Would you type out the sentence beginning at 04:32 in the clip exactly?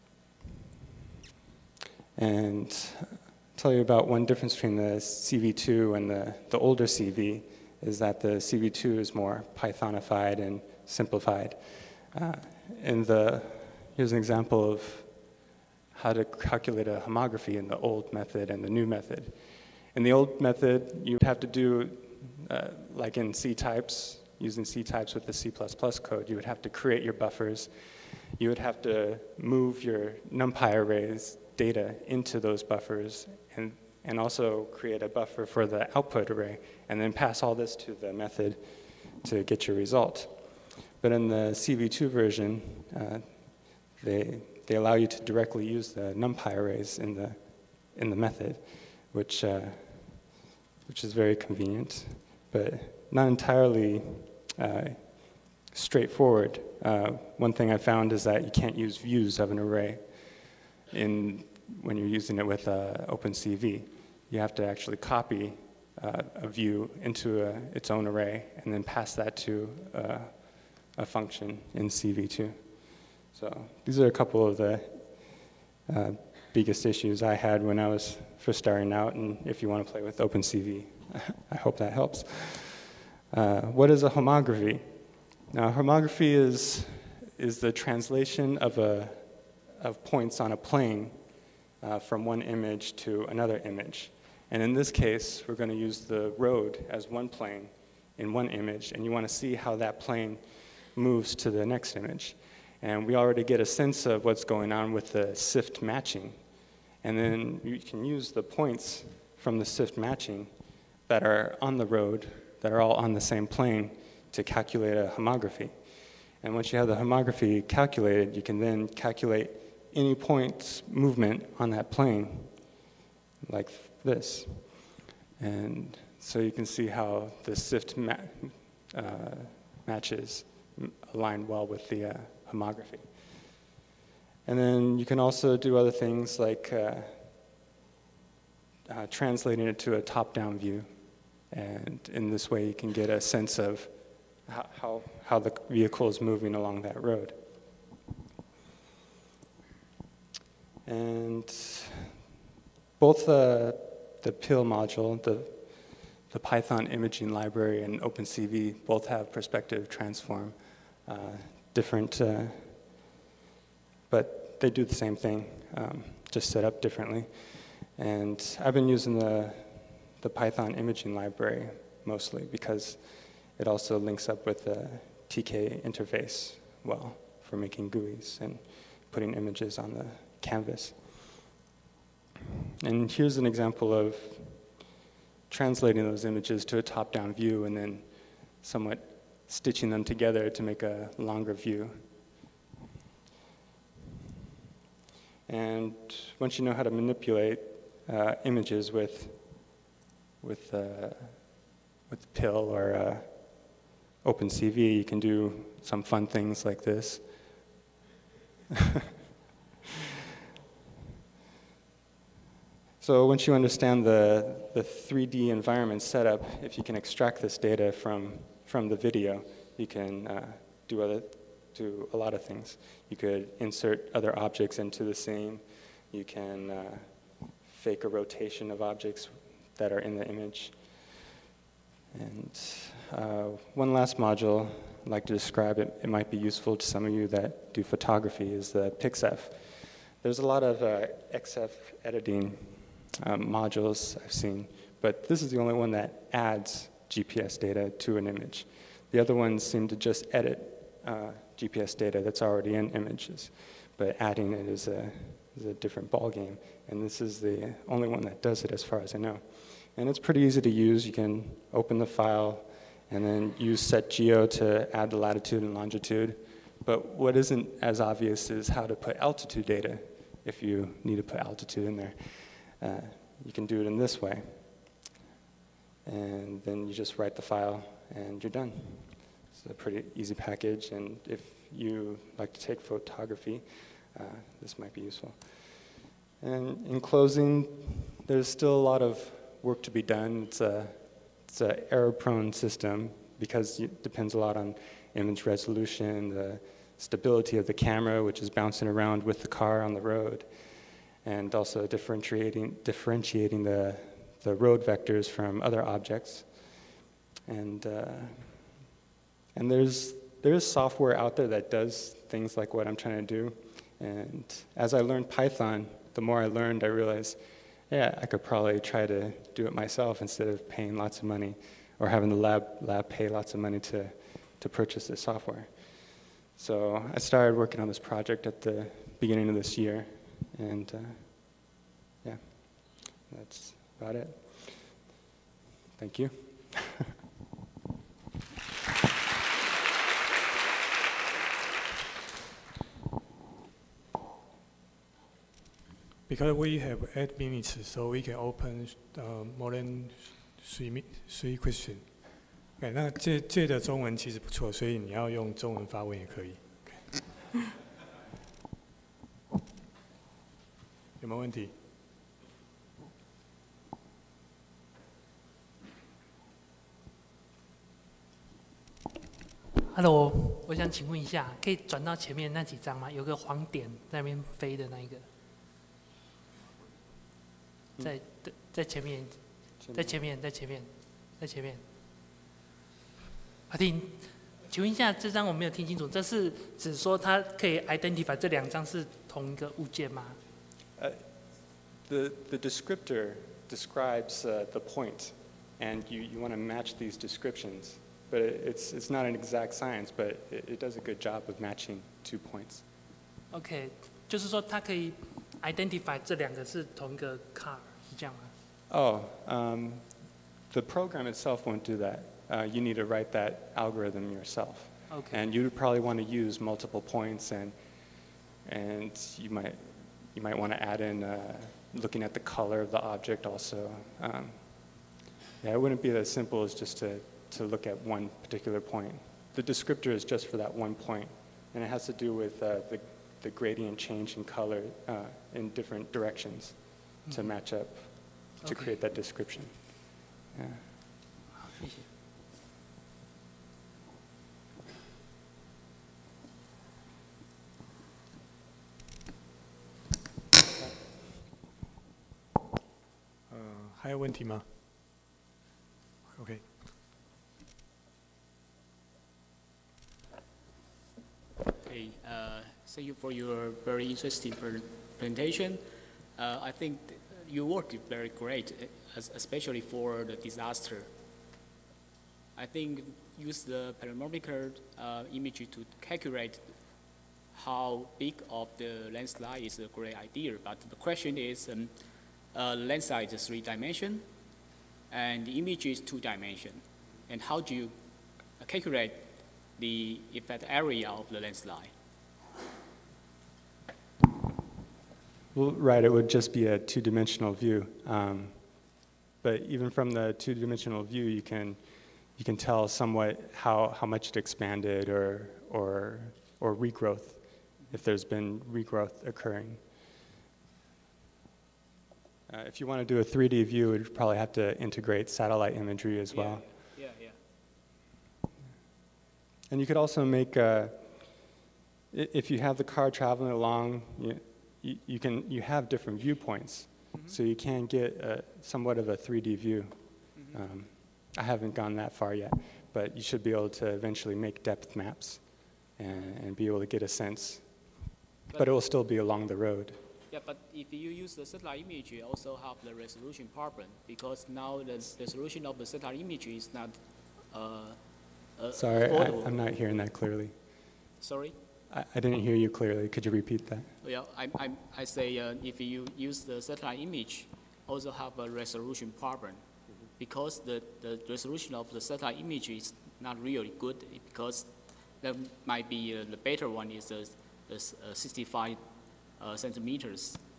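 Uh, you can do it in this way and then you just write the file and you're done.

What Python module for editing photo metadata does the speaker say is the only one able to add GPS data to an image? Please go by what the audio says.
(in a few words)
pexif.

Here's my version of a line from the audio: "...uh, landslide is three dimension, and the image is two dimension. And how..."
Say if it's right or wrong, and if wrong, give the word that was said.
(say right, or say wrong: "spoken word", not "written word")
right.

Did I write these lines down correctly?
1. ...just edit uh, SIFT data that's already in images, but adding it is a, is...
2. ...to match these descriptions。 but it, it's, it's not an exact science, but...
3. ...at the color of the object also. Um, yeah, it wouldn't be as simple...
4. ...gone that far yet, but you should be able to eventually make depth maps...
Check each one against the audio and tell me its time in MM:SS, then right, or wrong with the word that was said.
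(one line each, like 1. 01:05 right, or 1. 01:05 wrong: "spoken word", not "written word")
1. 04:09 wrong: "GPS", not "SIFT"
2. 06:36 right
3. 07:02 right
4. 08:51 right.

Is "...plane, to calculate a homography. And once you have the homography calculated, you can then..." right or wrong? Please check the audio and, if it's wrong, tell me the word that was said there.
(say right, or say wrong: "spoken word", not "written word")
right.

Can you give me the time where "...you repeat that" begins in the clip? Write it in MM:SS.
09:13.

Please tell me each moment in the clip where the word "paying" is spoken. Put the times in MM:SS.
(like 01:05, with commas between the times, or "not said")
05:20.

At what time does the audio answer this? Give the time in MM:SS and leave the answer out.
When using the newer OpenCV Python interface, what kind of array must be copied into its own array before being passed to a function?
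01:06.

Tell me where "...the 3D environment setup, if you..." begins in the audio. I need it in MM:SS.
03:34.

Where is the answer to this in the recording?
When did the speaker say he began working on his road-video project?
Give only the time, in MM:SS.
05:28.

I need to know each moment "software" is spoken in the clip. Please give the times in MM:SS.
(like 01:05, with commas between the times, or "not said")
05:10, 05:25.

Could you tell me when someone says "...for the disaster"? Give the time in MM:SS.
07:49.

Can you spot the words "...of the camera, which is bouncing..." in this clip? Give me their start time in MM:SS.
04:57.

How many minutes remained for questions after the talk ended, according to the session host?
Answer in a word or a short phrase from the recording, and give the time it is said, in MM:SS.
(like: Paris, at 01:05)
8, at 05:47.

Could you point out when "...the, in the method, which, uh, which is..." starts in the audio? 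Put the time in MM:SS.
00:47.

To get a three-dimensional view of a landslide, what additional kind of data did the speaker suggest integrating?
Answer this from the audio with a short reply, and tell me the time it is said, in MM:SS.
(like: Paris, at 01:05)
satellite imagery, at 08:35.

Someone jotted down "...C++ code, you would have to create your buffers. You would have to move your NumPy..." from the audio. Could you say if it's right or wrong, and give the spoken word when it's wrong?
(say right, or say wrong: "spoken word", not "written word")
right.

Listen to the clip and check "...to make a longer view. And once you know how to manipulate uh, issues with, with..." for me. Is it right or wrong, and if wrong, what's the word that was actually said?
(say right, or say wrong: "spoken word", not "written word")
wrong: "images", not "issues".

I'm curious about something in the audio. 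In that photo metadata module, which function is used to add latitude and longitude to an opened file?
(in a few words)
SetGeo.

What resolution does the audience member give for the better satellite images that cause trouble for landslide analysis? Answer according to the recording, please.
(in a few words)
65 centimeters.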